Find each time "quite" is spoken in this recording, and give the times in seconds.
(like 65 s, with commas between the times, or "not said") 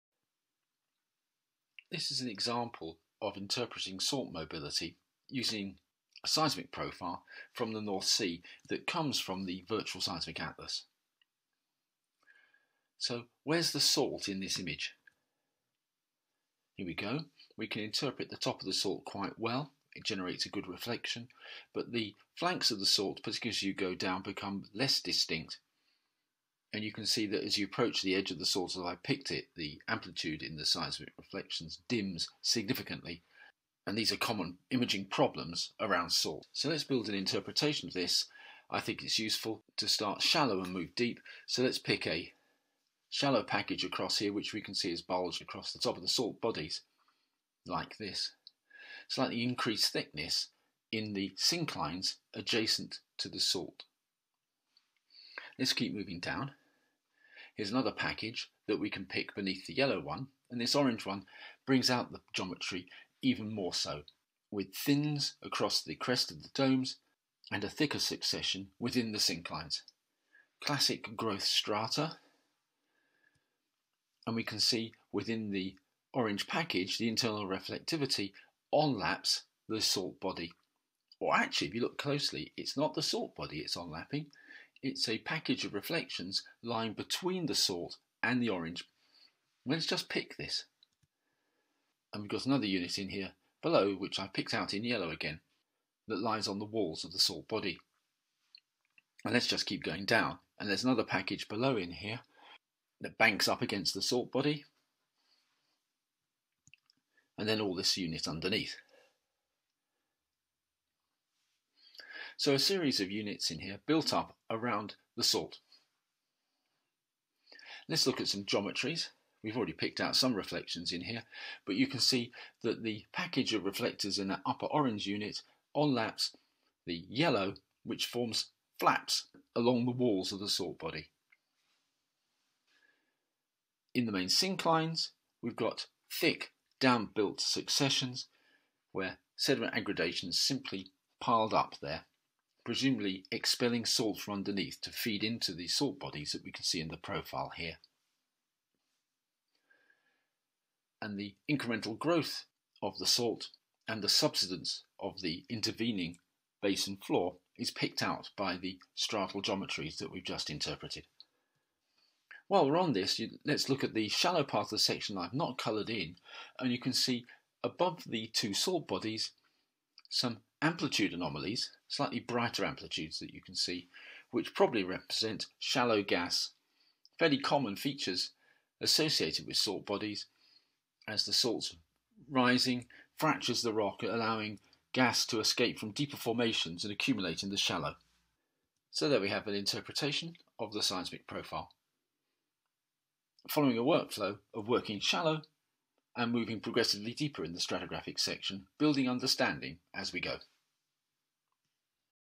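19 s.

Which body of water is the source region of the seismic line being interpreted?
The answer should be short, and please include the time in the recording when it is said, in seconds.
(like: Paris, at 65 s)
North Sea, at 7 s.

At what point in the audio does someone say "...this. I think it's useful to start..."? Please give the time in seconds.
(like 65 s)
37 s.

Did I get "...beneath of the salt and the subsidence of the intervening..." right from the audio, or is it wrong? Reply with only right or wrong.
wrong.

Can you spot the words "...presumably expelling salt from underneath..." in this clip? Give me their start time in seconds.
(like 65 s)
142 s.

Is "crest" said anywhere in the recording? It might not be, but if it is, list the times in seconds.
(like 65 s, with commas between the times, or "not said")
65 s.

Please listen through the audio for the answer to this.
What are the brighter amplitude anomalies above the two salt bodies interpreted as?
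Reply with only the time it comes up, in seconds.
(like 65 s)
175 s.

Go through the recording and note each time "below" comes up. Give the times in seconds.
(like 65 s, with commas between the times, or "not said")
93 s, 101 s.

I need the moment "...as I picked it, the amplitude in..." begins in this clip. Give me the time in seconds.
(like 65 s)
28 s.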